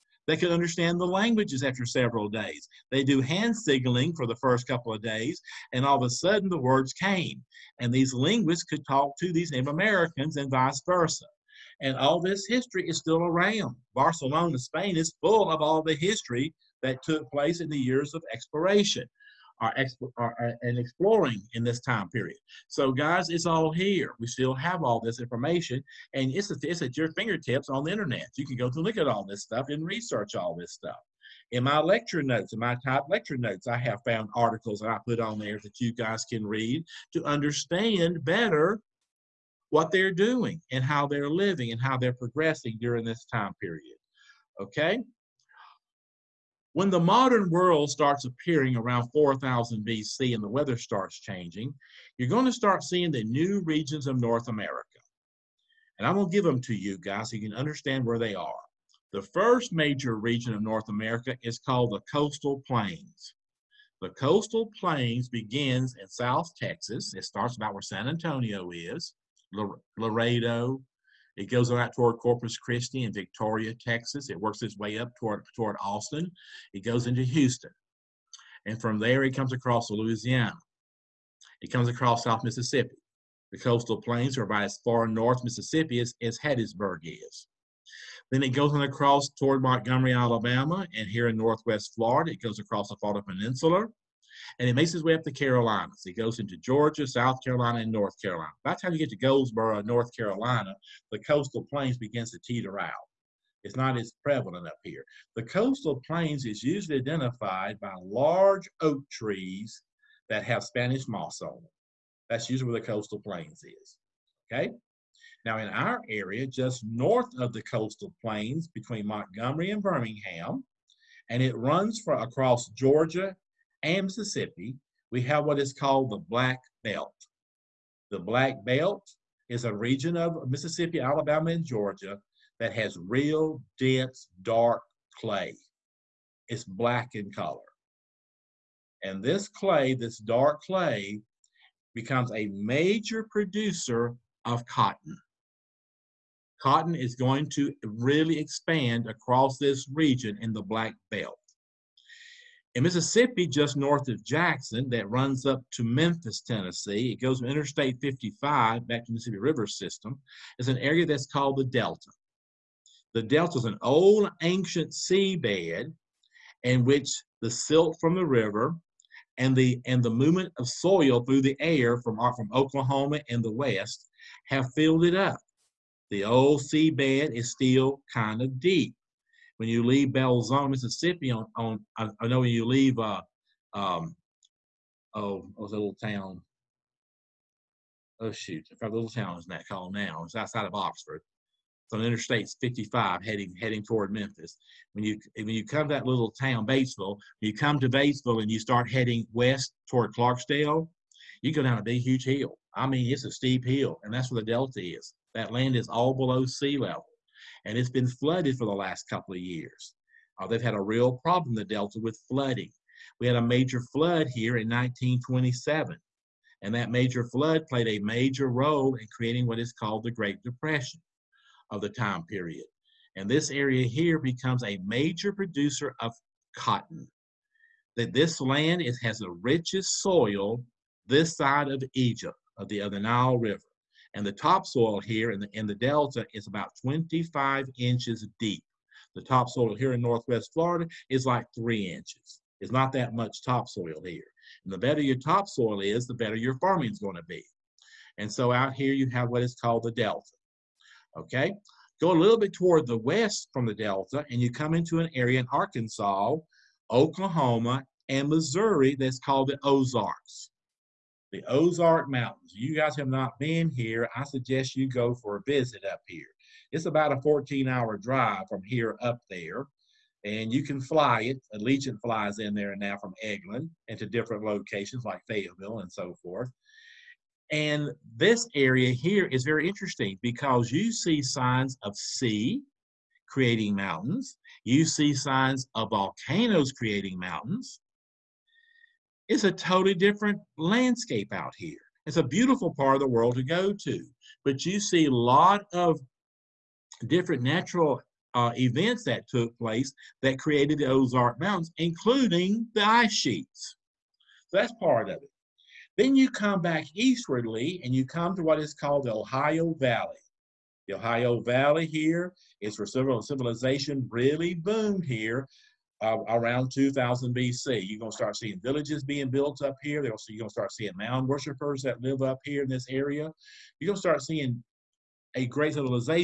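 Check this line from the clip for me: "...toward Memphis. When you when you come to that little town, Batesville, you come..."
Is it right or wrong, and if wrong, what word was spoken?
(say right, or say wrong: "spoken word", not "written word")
right.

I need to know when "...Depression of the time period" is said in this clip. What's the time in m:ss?
3:40.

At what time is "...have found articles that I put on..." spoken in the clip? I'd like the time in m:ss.
0:33.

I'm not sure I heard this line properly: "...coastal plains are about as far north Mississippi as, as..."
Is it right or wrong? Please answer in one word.
right.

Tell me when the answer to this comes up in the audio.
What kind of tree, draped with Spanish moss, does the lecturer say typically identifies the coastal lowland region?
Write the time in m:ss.
1:48.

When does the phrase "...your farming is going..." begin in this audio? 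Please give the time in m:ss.
4:06.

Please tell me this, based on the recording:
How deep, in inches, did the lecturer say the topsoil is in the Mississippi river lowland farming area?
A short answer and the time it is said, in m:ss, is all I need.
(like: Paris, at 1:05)
25 inches, at 3:56.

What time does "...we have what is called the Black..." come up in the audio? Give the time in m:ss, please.
2:05.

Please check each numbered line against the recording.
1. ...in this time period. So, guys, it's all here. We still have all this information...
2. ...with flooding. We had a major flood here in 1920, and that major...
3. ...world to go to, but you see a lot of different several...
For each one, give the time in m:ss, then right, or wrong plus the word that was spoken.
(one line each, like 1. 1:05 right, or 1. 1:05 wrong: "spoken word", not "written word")
1. 0:21 right
2. 3:32 wrong: "1927", not "1920"
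3. 4:53 wrong: "natural", not "several".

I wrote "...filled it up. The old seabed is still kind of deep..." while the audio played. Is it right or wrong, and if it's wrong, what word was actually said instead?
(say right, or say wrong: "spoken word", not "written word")
right.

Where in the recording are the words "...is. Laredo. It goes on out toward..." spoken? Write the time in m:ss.
1:08.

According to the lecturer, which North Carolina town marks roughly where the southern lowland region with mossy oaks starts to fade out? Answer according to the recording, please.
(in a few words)
Goldsboro.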